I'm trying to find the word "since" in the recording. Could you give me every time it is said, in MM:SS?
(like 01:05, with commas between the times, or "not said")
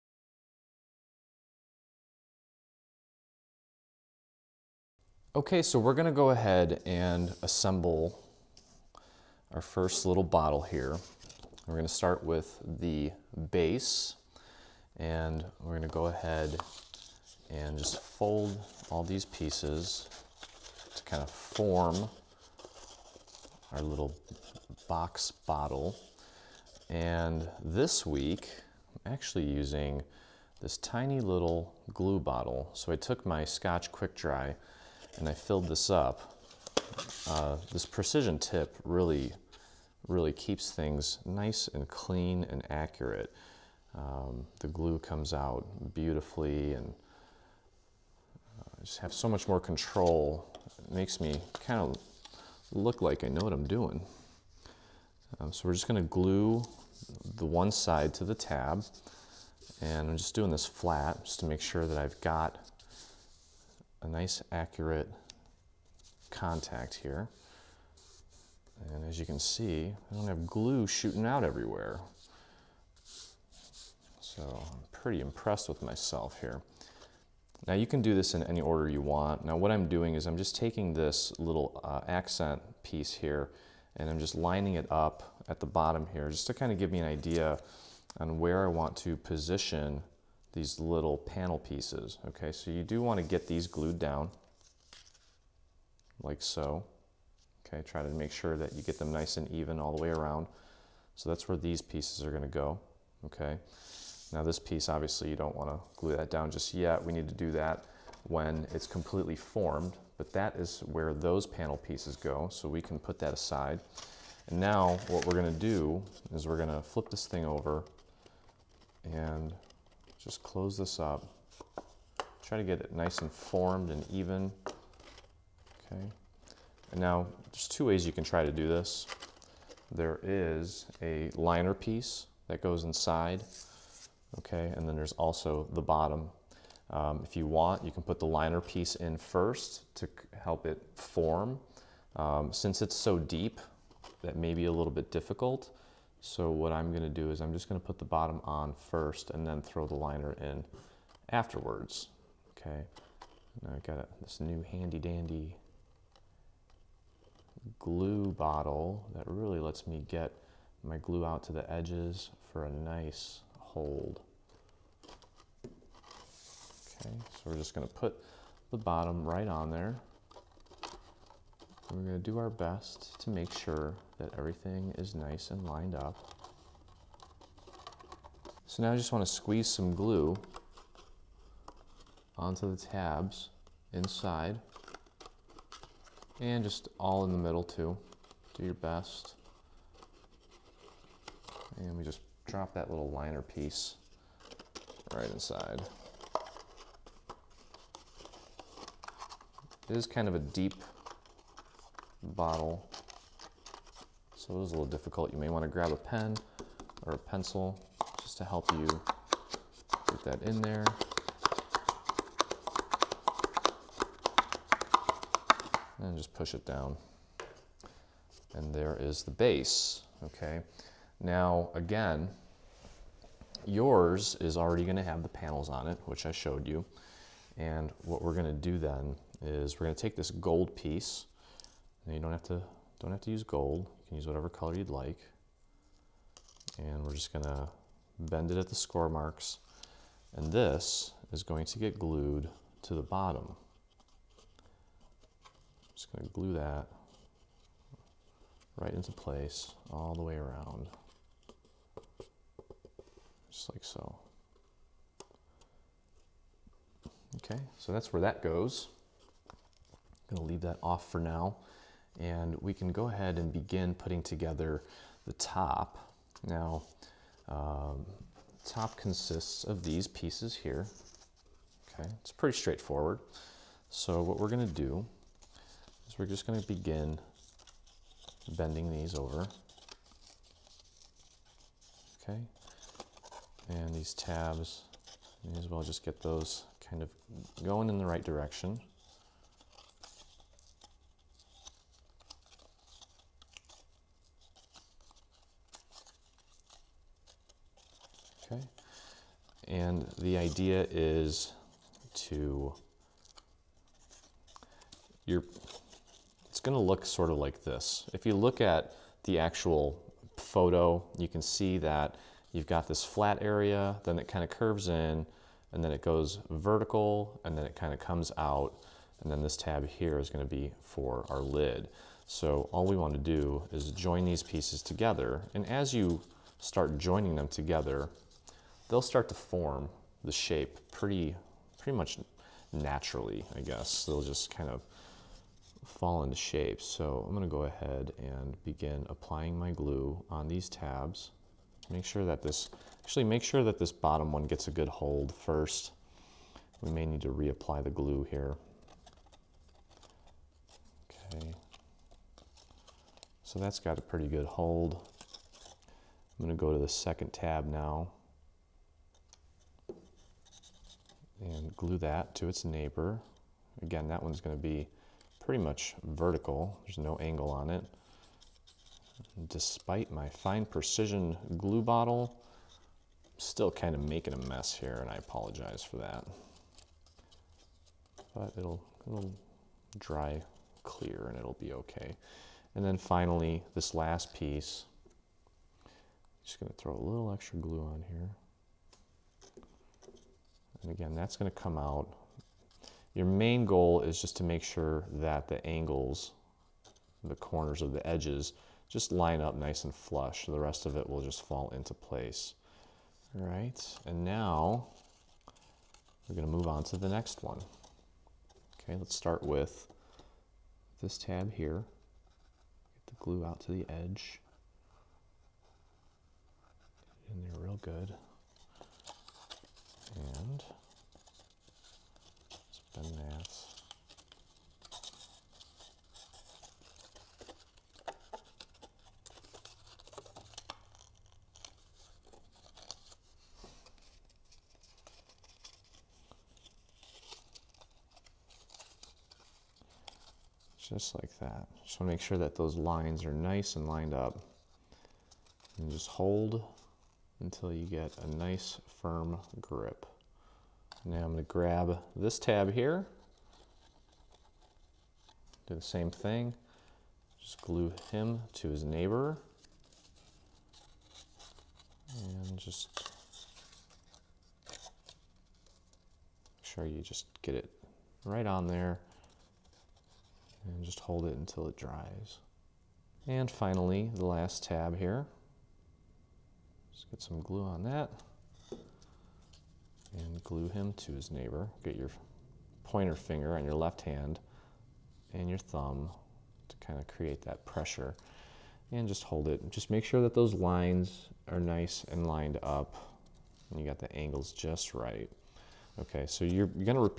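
02:22.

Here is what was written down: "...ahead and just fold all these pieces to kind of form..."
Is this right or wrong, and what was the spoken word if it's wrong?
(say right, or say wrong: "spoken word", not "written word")
right.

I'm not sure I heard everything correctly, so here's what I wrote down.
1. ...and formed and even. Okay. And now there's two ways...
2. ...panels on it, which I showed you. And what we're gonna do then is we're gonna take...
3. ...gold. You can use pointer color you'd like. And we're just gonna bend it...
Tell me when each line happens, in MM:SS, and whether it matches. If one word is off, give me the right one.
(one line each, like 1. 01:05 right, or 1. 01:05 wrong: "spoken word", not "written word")
1. 02:03 right
2. 03:45 right
3. 03:53 wrong: "whatever", not "pointer".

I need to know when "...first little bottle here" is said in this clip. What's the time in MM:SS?
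00:09.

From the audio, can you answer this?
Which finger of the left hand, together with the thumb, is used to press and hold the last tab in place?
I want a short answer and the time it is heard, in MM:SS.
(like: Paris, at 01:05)
pointer finger, at 08:02.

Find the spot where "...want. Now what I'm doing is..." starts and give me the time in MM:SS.
01:18.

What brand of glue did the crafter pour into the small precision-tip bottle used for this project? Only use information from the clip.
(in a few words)
Scotch Quick Dry.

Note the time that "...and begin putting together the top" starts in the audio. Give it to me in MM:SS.
04:23.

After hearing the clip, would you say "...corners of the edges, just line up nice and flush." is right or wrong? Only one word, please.
right.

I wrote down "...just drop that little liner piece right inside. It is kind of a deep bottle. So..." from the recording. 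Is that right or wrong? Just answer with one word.
right.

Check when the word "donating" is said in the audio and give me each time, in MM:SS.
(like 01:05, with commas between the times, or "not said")
not said.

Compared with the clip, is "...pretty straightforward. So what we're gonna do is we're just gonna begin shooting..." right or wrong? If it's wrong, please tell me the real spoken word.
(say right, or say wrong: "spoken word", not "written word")
wrong: "bending", not "shooting".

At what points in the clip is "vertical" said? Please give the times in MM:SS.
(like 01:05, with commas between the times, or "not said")
05:16, 06:06.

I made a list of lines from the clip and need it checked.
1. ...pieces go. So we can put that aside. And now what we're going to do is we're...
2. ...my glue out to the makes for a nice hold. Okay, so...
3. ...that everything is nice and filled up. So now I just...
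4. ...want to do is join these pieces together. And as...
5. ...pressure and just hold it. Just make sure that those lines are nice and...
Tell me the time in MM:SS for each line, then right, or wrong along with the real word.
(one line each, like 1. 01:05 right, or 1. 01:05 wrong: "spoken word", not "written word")
1. 01:51 right
2. 02:40 wrong: "edges", not "makes"
3. 02:54 wrong: "lined", not "filled"
4. 05:22 right
5. 08:07 right.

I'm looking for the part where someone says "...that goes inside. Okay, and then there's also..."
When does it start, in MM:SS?
02:12.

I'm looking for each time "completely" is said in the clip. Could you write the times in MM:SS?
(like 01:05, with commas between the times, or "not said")
01:48.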